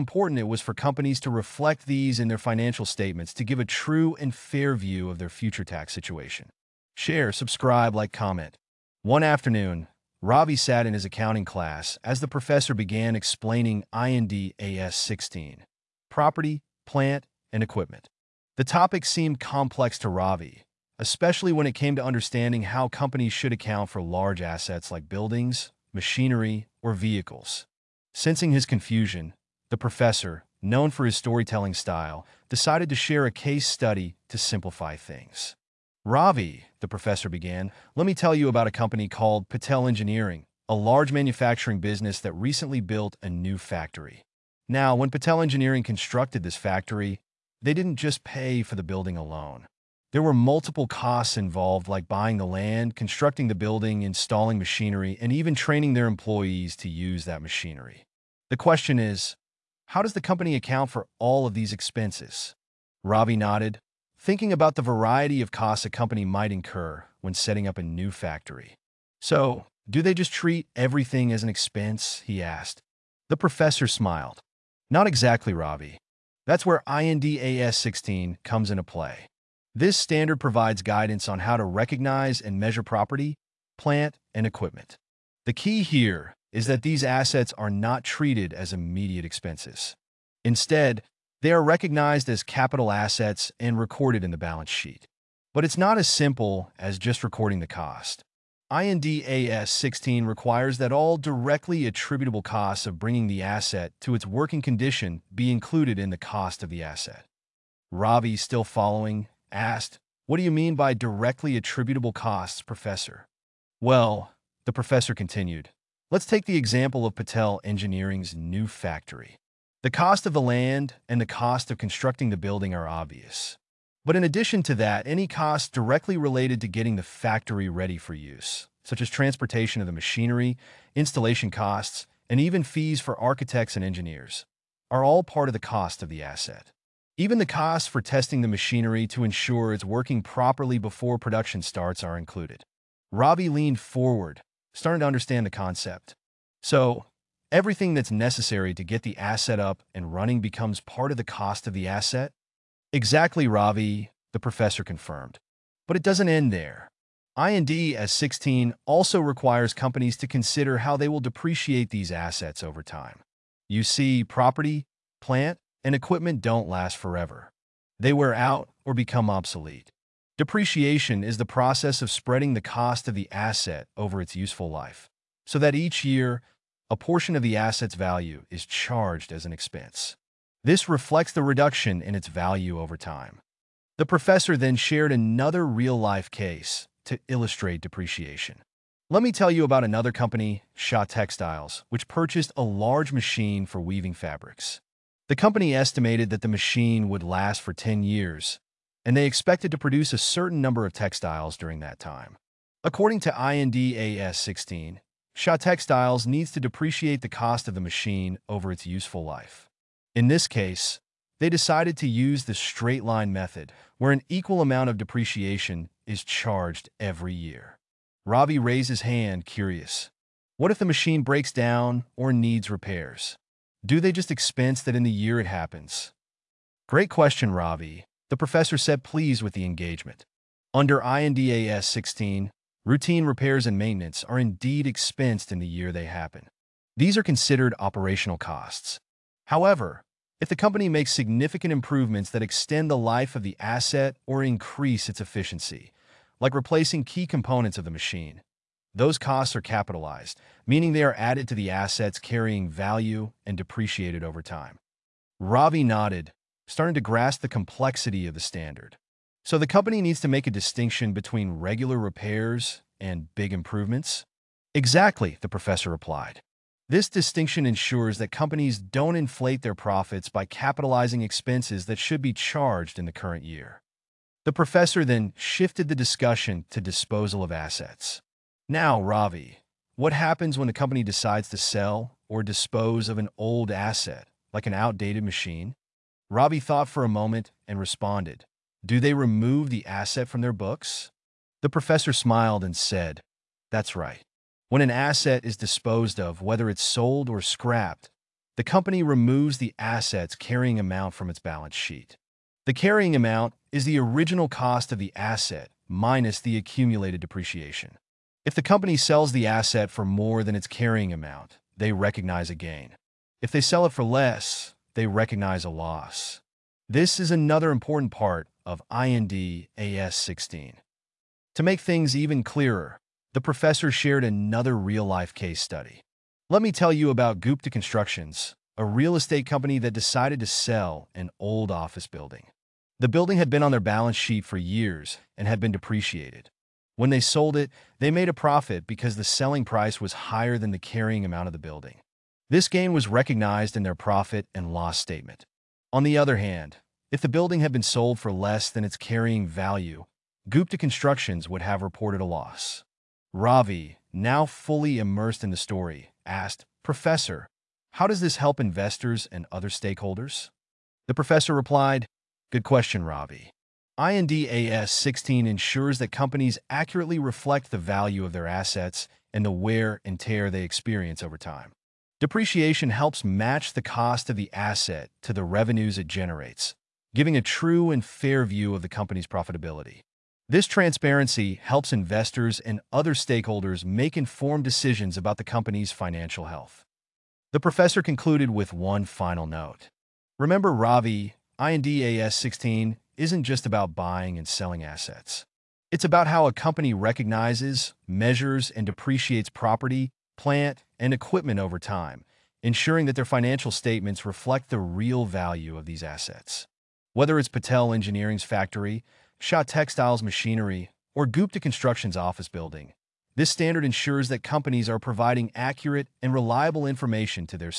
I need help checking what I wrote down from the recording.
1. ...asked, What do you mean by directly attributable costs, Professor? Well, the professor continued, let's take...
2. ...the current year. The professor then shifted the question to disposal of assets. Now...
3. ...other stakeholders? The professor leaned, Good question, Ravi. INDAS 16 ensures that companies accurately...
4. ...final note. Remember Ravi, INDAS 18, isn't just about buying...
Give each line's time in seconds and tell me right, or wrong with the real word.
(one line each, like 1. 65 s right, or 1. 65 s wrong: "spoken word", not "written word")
1. 109 s right
2. 273 s wrong: "discussion", not "question"
3. 359 s wrong: "replied", not "leaned"
4. 389 s wrong: "16", not "18".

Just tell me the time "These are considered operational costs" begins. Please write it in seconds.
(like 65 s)
236 s.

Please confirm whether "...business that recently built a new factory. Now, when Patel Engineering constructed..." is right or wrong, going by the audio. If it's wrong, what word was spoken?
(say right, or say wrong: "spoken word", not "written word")
right.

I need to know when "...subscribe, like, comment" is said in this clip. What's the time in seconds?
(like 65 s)
7 s.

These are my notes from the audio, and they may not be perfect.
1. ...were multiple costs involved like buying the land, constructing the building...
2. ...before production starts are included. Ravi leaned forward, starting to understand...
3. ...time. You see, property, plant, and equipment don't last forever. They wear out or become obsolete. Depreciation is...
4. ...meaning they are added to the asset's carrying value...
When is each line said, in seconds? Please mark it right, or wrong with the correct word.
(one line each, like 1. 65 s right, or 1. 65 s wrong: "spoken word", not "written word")
1. 50 s right
2. 140 s right
3. 162 s right
4. 250 s right.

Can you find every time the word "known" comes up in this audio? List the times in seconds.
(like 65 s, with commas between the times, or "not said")
30 s.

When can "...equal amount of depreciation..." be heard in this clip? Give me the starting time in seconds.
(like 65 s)
214 s.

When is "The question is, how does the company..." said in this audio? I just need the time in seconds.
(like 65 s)
58 s.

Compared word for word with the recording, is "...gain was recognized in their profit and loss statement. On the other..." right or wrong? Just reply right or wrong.
right.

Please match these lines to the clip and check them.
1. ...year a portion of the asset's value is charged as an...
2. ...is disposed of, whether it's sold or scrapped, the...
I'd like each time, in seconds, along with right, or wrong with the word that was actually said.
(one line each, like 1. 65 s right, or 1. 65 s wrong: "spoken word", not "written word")
1. 176 s right
2. 295 s right.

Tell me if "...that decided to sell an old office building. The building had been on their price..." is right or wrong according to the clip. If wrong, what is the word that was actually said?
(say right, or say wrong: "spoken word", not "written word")
wrong: "balance", not "price".